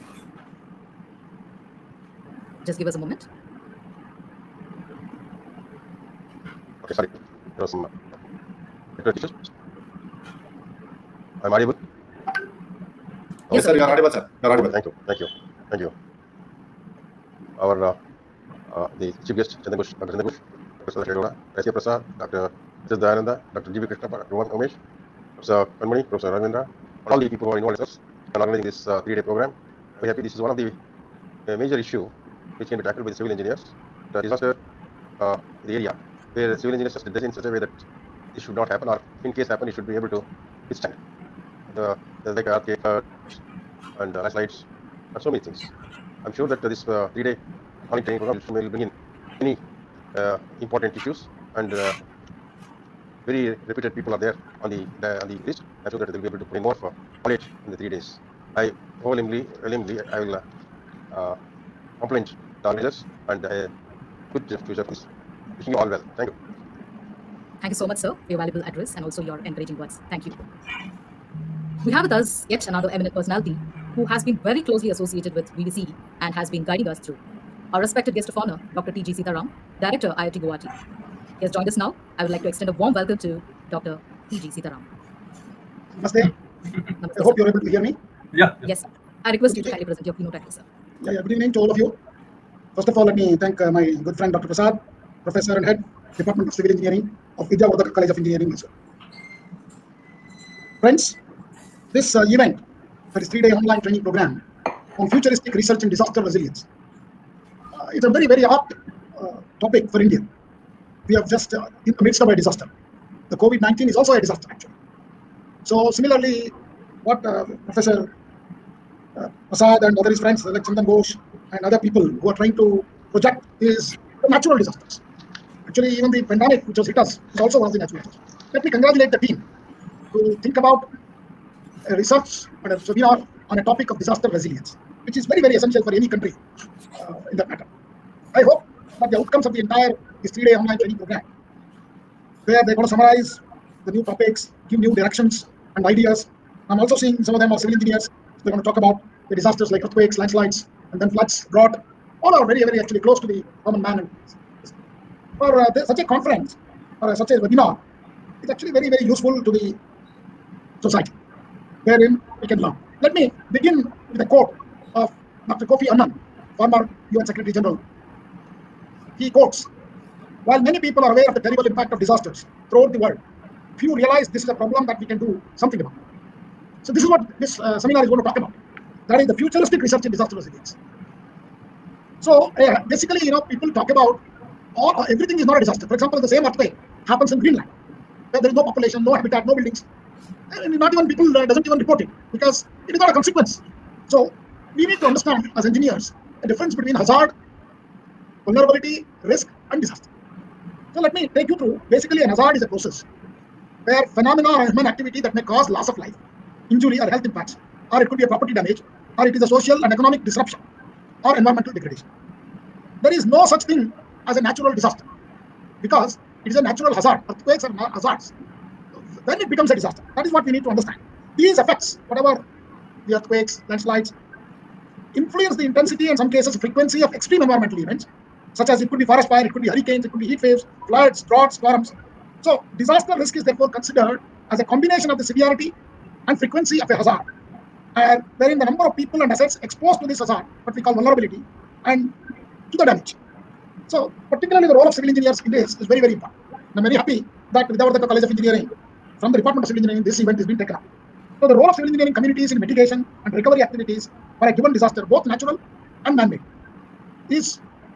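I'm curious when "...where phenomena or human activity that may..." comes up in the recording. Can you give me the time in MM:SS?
03:23.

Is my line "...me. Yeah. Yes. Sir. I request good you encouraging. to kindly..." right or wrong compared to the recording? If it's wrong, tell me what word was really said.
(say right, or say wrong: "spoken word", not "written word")
wrong: "evening", not "encouraging".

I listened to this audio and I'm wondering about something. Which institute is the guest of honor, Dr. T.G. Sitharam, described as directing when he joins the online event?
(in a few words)
IIT Guwahati.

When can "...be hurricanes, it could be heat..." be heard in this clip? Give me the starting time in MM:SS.
03:49.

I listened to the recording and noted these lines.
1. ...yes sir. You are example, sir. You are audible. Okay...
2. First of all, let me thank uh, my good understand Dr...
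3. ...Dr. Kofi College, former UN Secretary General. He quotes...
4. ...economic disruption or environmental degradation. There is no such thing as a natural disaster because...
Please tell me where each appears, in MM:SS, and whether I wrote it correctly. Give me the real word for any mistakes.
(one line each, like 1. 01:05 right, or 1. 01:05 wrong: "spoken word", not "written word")
1. 00:13 wrong: "audible", not "example"
2. 01:32 wrong: "friend", not "understand"
3. 02:45 wrong: "Annan", not "College"
4. 03:29 right.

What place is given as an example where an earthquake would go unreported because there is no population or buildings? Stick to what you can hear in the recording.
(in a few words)
Greenland.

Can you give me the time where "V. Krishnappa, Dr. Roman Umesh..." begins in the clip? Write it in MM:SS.
00:23.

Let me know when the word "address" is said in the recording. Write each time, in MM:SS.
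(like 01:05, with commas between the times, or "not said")
01:08, 01:30.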